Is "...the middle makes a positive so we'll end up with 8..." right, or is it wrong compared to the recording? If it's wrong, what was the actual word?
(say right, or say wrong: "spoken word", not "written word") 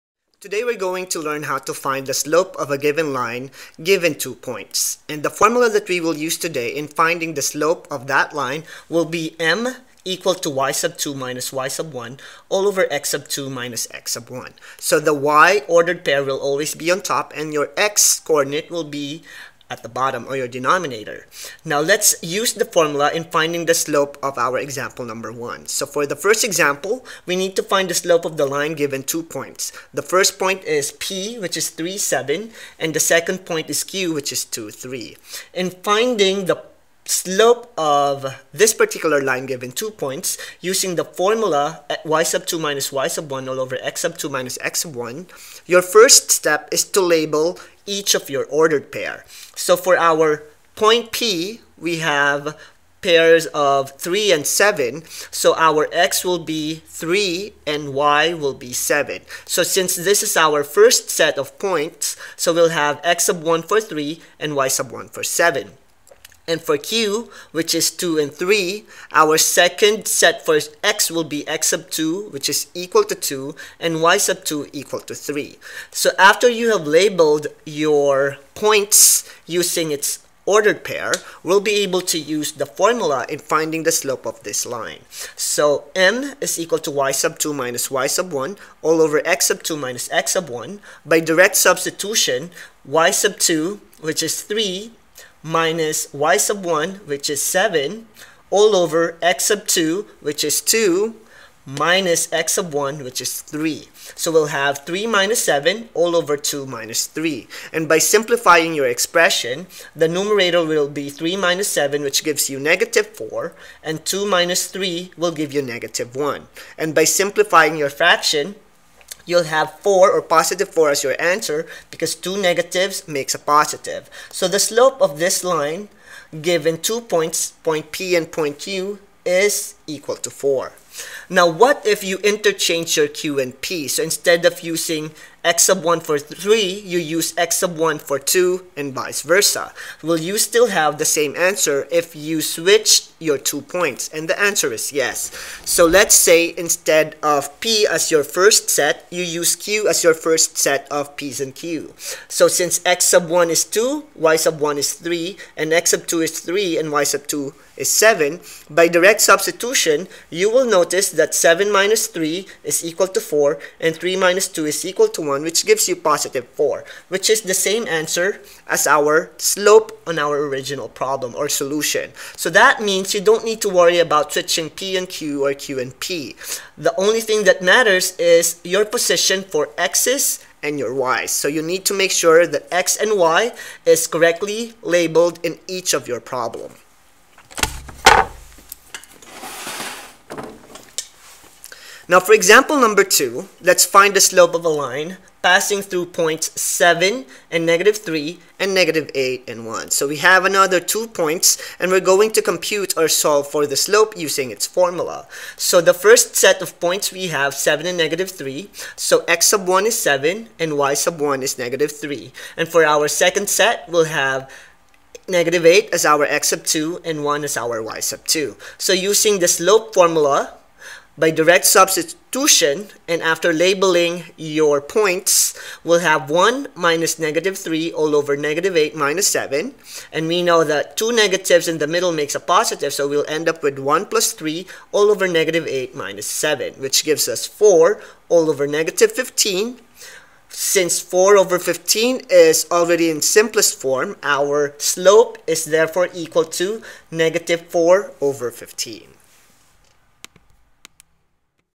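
wrong: "1", not "8".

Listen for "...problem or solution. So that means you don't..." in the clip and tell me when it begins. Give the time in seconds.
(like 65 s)
170 s.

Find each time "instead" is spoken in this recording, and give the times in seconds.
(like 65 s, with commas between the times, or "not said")
134 s, 146 s.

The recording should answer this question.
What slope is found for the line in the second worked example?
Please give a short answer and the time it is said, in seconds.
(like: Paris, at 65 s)
-4/15, at 247 s.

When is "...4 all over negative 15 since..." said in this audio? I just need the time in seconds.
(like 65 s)
237 s.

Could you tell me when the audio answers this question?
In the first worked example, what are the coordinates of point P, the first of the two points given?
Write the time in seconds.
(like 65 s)
31 s.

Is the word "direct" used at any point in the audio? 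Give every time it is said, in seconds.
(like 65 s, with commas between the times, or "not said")
91 s, 158 s, 221 s.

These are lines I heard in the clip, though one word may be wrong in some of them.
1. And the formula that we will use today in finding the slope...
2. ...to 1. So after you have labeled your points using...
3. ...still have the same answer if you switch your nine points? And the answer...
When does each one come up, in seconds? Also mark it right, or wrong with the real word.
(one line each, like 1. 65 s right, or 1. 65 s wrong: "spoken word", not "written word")
1. 5 s right
2. 75 s wrong: "3", not "1"
3. 140 s wrong: "two", not "nine".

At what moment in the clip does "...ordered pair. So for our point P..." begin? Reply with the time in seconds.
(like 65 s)
48 s.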